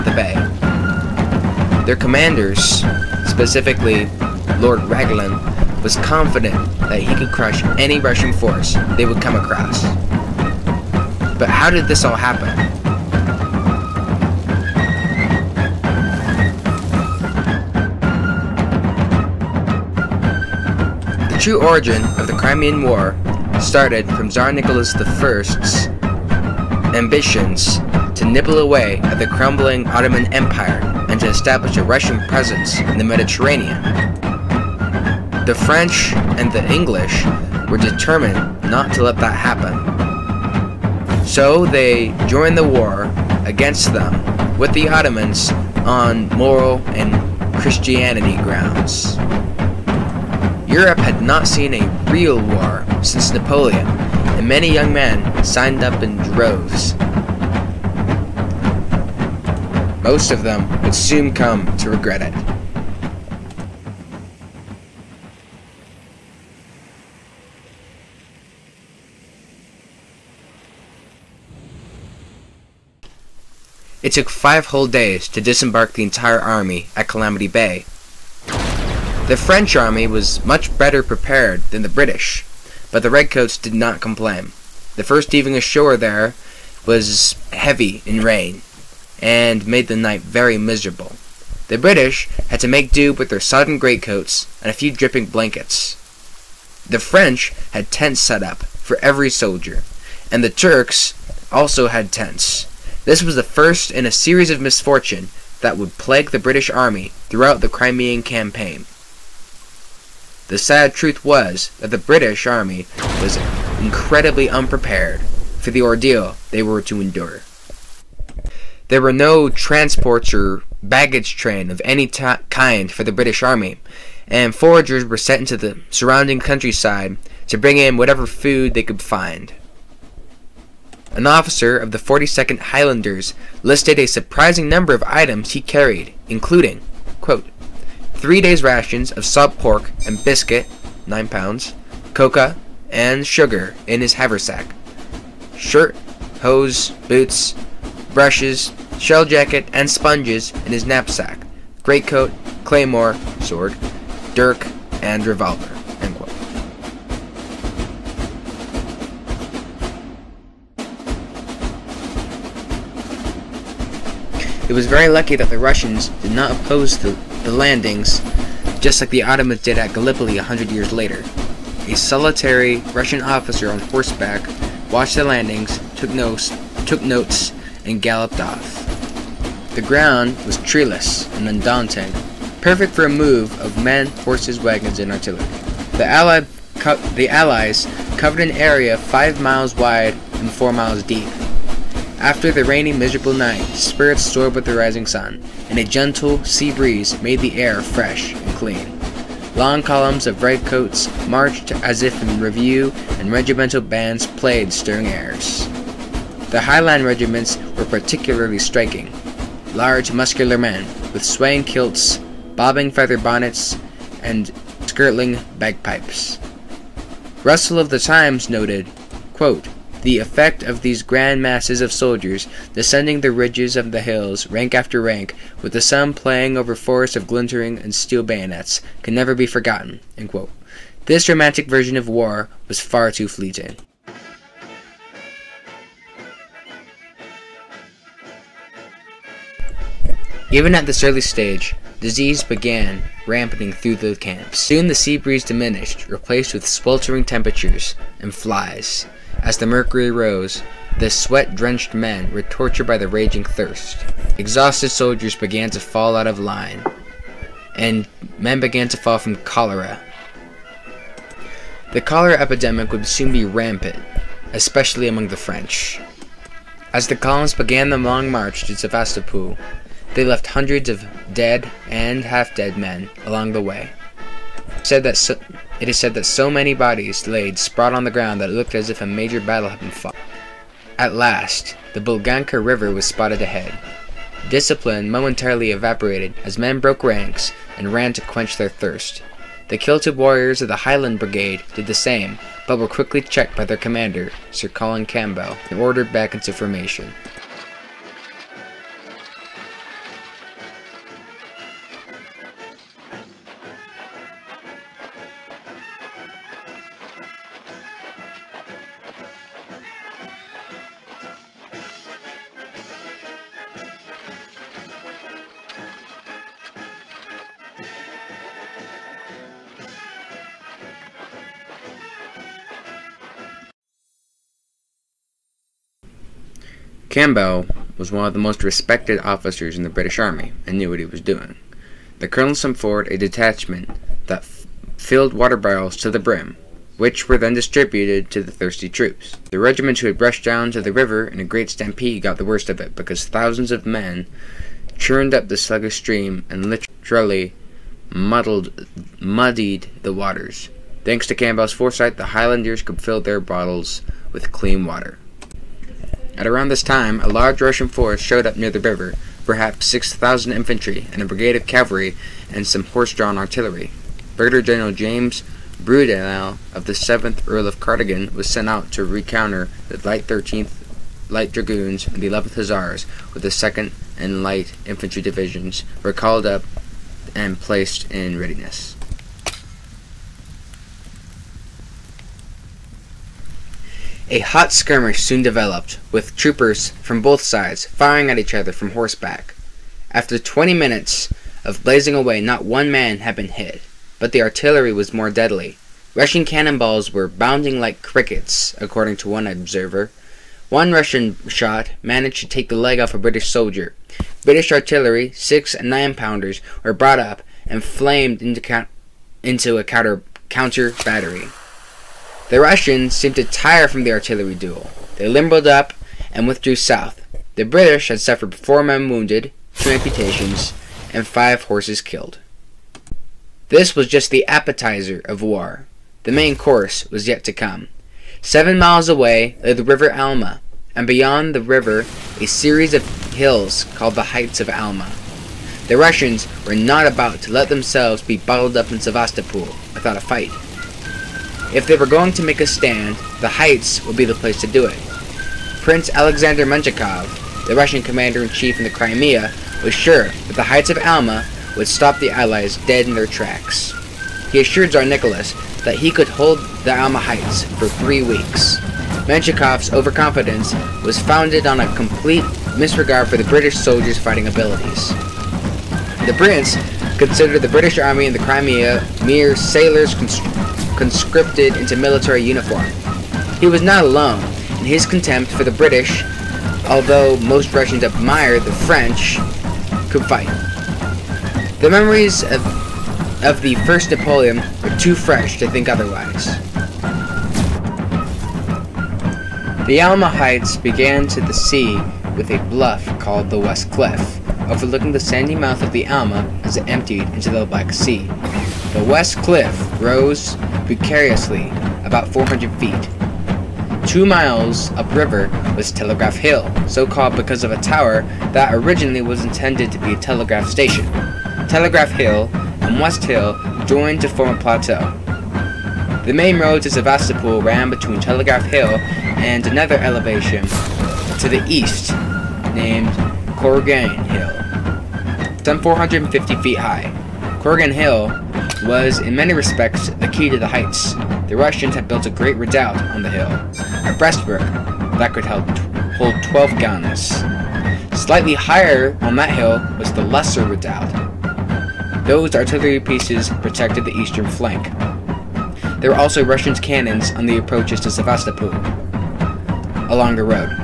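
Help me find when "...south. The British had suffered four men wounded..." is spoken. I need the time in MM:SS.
06:56.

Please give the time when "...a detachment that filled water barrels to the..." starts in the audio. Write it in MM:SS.
05:33.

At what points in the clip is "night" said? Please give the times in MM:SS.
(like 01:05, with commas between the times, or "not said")
01:29, 03:13.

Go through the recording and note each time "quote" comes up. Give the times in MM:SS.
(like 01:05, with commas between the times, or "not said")
02:17, 03:39.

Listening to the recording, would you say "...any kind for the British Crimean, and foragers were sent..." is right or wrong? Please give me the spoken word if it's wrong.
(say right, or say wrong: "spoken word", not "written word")
wrong: "Army", not "Crimean".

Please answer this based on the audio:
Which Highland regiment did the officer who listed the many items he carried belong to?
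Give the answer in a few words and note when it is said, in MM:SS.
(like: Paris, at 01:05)
42nd Highlanders, at 02:11.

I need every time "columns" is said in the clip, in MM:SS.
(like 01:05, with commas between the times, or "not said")
03:19, 04:27.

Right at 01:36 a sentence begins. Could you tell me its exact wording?
The French had tents set up for every soldier, and the Turks also had tents.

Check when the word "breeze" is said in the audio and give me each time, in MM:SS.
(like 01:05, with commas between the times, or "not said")
03:16, 04:05.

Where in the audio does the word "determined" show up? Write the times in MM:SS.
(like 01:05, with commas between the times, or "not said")
00:37.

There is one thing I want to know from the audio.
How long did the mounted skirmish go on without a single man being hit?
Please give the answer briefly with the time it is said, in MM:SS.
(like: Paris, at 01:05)
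20 minutes, at 06:30.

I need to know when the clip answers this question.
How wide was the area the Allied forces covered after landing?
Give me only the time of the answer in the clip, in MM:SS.
03:08.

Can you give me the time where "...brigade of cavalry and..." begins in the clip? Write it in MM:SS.
06:01.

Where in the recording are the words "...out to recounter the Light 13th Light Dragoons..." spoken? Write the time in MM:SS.
06:08.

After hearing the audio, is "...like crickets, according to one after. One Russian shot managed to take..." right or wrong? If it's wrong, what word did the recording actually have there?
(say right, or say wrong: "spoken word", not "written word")
wrong: "observer", not "after".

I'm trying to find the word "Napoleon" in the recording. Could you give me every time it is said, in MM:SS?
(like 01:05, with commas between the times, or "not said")
00:53, 08:04.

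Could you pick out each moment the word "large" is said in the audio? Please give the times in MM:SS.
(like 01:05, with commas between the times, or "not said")
03:29, 05:57.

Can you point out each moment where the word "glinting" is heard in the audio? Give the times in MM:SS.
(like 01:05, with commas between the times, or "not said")
03:47.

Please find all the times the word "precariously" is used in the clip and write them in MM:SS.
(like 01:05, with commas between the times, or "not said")
08:20.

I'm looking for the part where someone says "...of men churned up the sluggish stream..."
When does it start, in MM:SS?
05:43.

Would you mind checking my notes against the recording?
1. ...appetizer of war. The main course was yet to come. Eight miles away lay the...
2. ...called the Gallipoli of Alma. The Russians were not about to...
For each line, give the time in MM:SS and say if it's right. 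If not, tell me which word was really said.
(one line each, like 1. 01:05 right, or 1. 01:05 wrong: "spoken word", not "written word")
1. 07:04 wrong: "Seven", not "Eight"
2. 07:13 wrong: "Heights", not "Gallipoli".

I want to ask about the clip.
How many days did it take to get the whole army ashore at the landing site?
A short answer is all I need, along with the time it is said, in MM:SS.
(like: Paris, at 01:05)
5, at 01:14.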